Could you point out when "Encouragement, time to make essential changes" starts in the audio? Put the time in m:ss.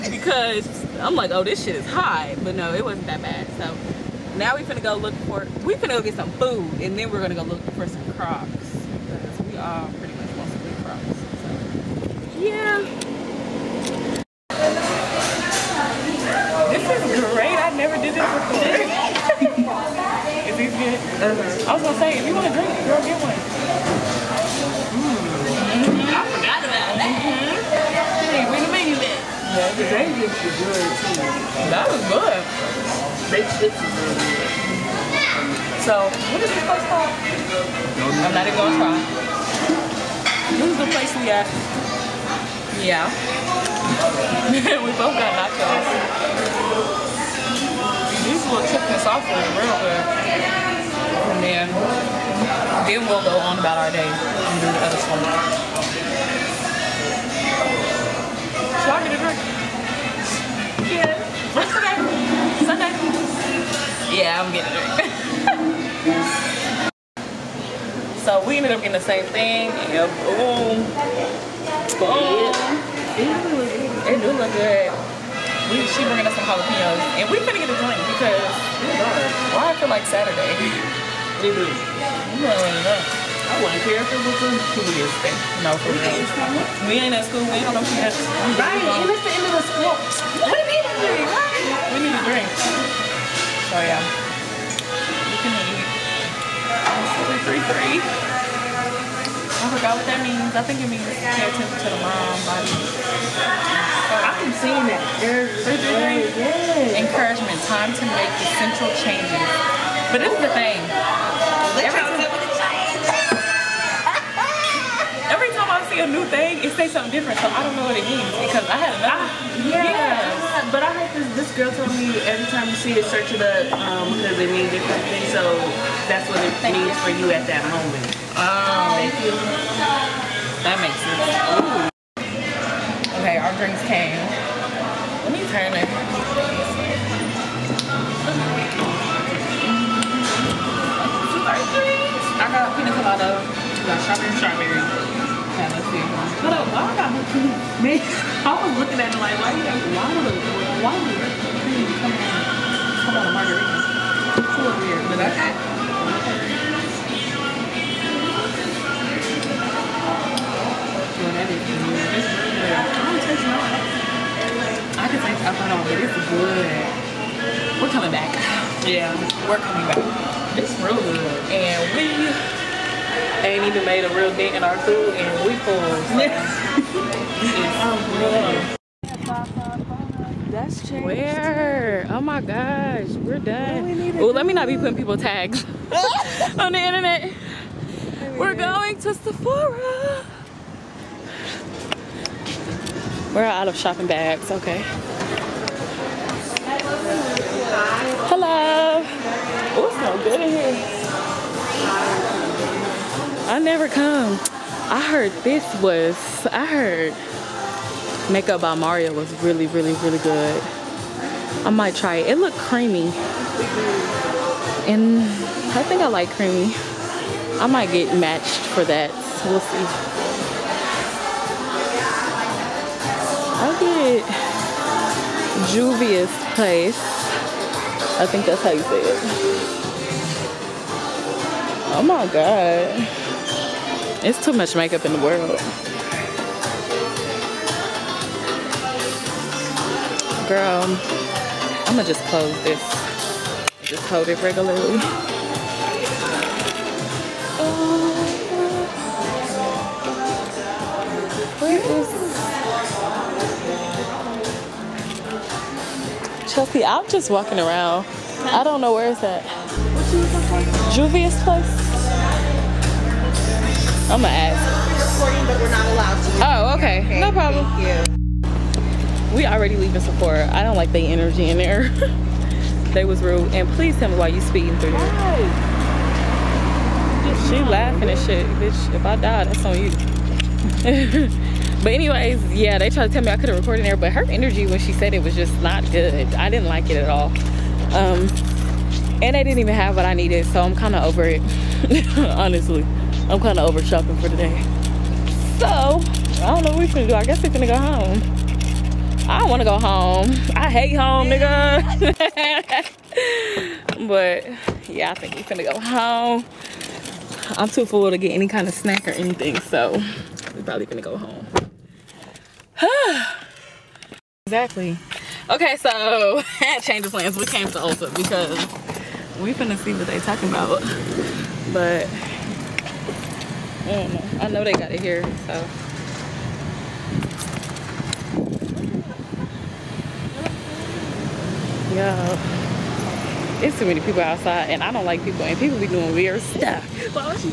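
1:46.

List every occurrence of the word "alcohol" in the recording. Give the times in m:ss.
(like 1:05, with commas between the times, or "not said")
2:45.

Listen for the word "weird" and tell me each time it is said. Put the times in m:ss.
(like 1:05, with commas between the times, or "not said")
2:34, 5:36.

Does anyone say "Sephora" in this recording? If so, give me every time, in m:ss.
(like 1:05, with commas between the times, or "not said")
3:09, 4:30.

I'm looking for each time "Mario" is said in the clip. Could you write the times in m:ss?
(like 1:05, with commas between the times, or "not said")
3:28.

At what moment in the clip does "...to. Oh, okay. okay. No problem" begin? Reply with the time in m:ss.
4:26.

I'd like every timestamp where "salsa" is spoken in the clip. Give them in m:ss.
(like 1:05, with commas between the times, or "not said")
0:49.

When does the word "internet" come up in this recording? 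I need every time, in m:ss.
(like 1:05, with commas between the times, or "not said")
3:06.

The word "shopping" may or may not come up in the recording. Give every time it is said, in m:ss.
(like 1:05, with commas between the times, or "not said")
3:13, 4:53.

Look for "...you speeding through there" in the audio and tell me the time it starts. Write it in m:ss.
4:34.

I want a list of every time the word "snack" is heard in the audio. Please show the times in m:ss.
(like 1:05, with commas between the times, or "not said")
5:08.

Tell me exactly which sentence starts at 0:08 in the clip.
Because we are pretty much want some crocs.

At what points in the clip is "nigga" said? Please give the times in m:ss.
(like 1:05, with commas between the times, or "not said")
5:01.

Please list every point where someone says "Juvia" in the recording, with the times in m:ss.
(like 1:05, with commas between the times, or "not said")
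3:45, 4:20.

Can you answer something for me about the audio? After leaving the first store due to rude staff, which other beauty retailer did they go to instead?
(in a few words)
Ulta.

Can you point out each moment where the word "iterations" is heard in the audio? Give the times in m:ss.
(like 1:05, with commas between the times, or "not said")
not said.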